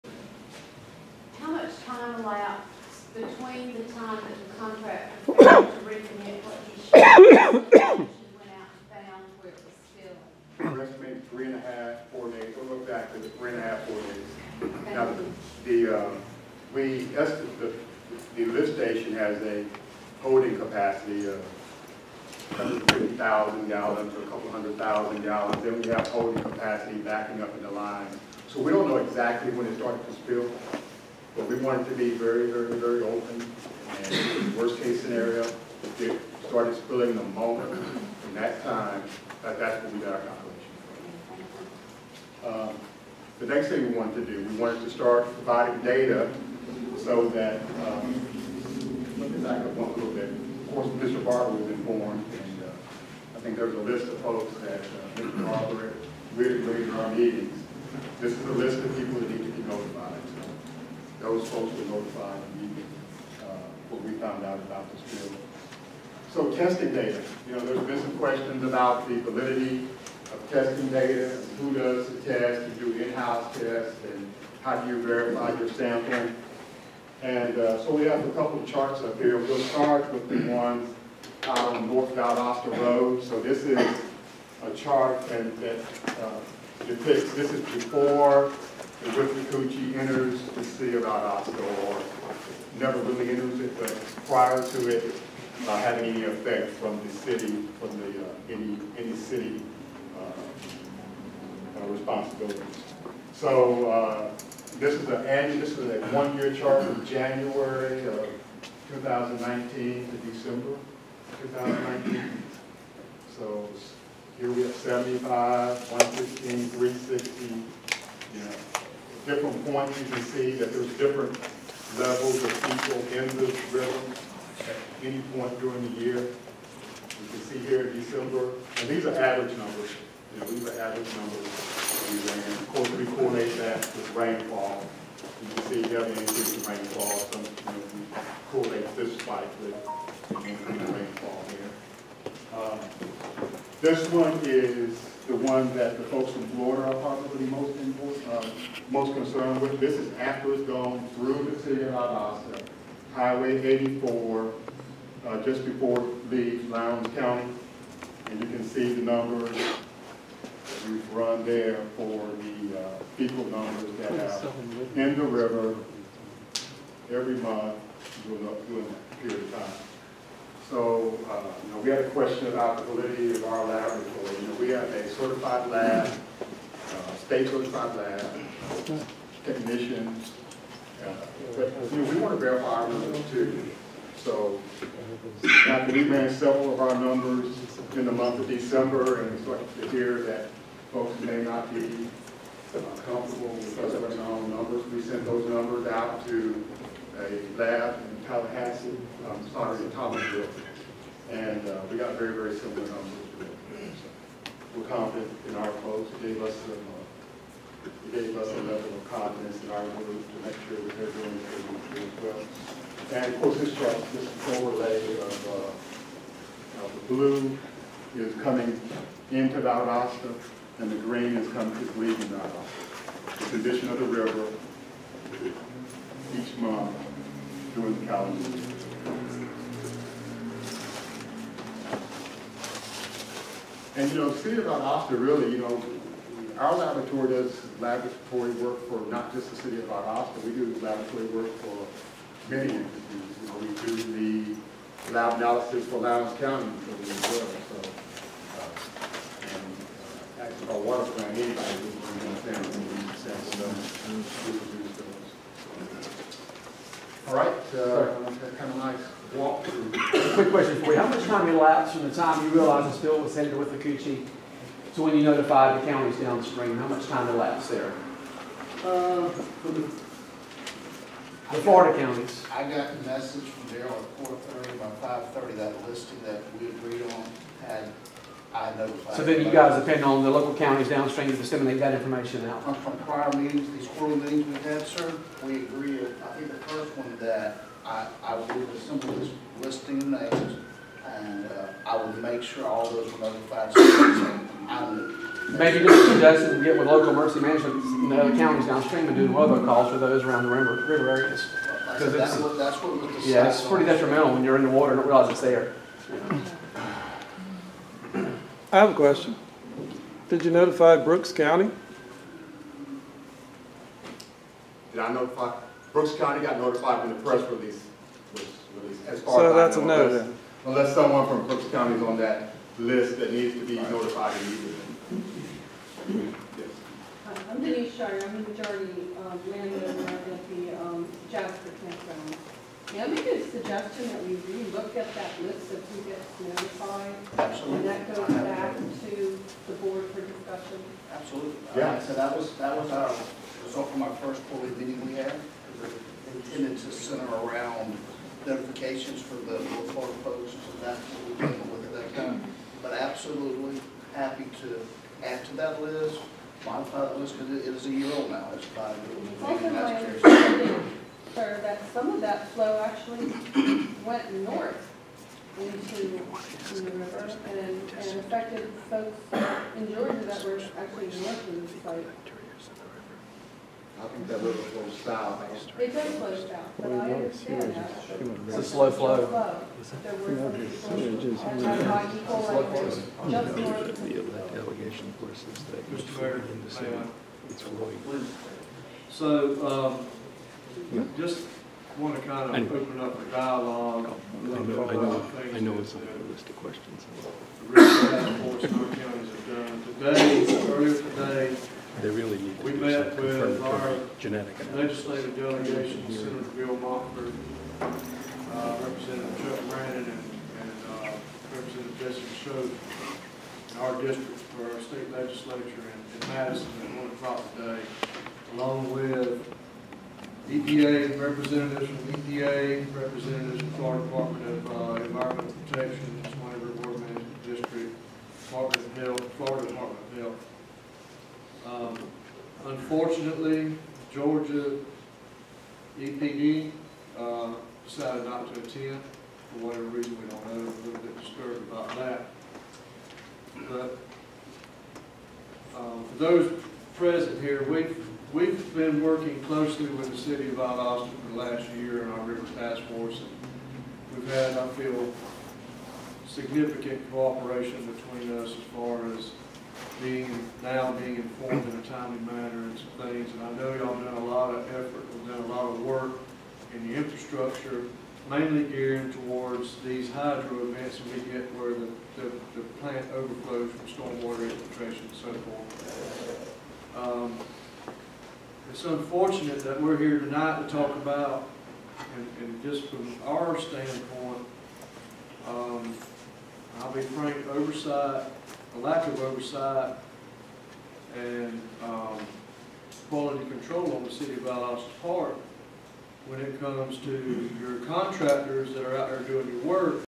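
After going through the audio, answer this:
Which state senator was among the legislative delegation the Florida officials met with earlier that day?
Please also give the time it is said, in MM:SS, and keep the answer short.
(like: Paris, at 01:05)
Bill Montford, at 06:46.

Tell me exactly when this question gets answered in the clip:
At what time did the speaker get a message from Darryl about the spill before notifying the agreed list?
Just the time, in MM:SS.
04:34.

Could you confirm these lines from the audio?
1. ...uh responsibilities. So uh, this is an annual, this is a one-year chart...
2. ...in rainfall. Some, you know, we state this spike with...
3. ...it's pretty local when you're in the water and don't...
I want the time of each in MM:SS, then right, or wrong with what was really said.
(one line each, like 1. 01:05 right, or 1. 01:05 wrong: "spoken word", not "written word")
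1. 01:41 right
2. 02:16 wrong: "correlate", not "state"
3. 05:03 wrong: "detrimental", not "local".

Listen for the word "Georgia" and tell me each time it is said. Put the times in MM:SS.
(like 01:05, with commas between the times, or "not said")
06:09, 07:14.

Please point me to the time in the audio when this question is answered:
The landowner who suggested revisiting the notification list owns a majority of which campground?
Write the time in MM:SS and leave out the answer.
05:31.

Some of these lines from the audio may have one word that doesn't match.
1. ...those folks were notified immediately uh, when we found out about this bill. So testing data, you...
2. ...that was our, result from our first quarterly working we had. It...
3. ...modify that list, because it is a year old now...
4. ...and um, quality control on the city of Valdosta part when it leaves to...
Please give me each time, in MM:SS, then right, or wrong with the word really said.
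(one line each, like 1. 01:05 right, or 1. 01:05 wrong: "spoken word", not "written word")
1. 01:01 right
2. 05:42 wrong: "meeting", not "working"
3. 05:56 right
4. 08:11 wrong: "comes", not "leaves".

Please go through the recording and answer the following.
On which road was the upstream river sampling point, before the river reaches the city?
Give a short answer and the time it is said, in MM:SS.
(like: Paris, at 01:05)
North Valdosta Road, at 01:21.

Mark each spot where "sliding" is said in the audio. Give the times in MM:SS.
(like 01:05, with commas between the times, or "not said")
not said.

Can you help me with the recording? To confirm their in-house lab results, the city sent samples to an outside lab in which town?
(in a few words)
Thomasville.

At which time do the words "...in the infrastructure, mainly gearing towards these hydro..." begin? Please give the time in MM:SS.
07:46.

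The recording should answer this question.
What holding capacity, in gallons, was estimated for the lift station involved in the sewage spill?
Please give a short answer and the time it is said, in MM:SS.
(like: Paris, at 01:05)
150,000 gallons, at 00:22.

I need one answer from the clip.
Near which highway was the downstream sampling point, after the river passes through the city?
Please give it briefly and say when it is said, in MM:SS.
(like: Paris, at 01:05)
Highway 84, at 02:33.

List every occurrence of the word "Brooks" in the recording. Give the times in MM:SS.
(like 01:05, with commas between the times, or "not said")
05:10, 05:15, 05:21.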